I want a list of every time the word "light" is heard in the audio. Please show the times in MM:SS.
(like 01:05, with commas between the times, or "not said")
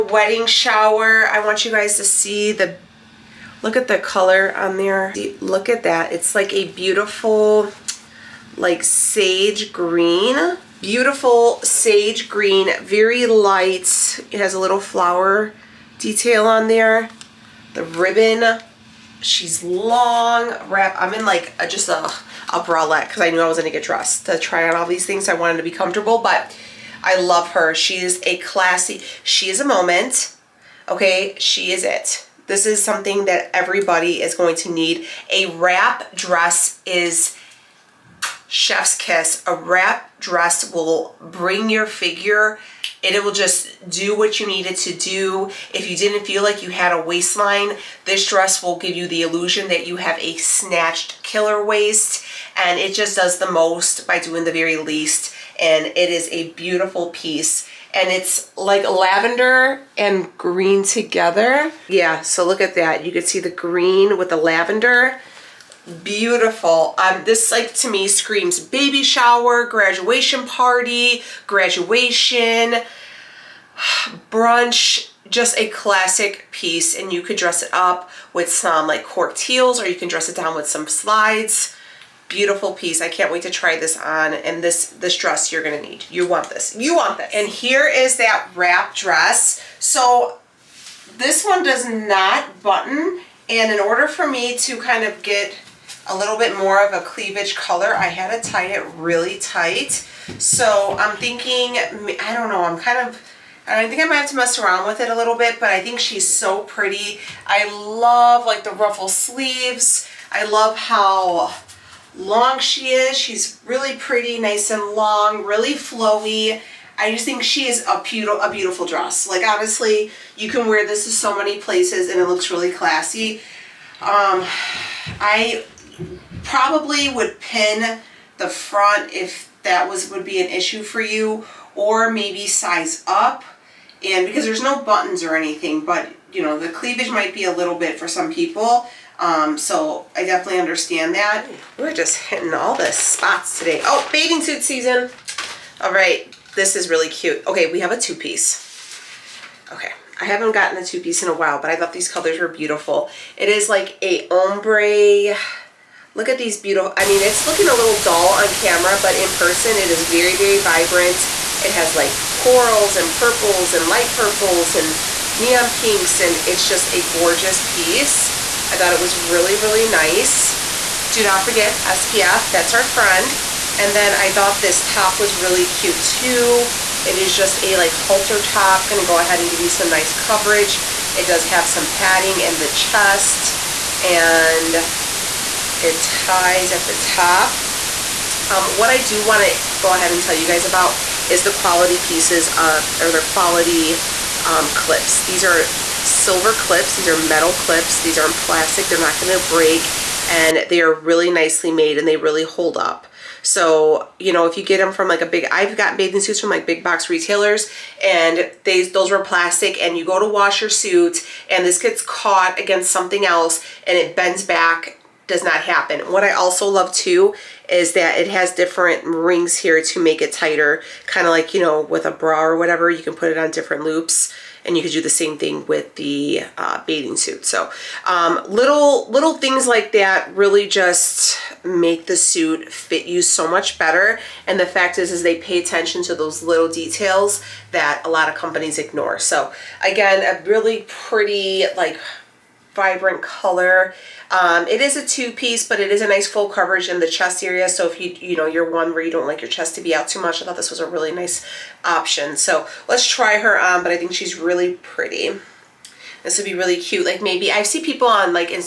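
00:13, 02:43.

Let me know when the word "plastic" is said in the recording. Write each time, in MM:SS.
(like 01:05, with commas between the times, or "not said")
03:18, 03:29.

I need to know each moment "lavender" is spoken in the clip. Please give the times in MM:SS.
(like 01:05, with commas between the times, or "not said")
00:58, 01:04.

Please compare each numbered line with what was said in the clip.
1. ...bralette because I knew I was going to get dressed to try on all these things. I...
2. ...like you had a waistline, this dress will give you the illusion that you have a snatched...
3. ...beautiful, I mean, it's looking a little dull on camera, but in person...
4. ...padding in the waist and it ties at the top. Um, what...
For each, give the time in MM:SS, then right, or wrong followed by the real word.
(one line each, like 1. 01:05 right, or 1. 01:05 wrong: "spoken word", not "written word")
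1. 00:22 right
2. 00:46 right
3. 02:36 right
4. 03:01 wrong: "chest", not "waist".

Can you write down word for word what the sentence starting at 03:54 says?
And the fact is, is they pay attention to those little details that a lot of companies ignore.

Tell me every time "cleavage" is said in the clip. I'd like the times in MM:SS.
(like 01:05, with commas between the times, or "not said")
01:37, 02:16.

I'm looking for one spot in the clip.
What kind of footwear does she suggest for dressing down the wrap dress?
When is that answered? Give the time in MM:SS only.
01:20.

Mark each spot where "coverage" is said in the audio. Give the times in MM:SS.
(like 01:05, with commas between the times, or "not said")
03:00, 04:06.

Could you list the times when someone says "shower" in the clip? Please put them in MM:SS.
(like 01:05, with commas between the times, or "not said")
00:00, 01:09.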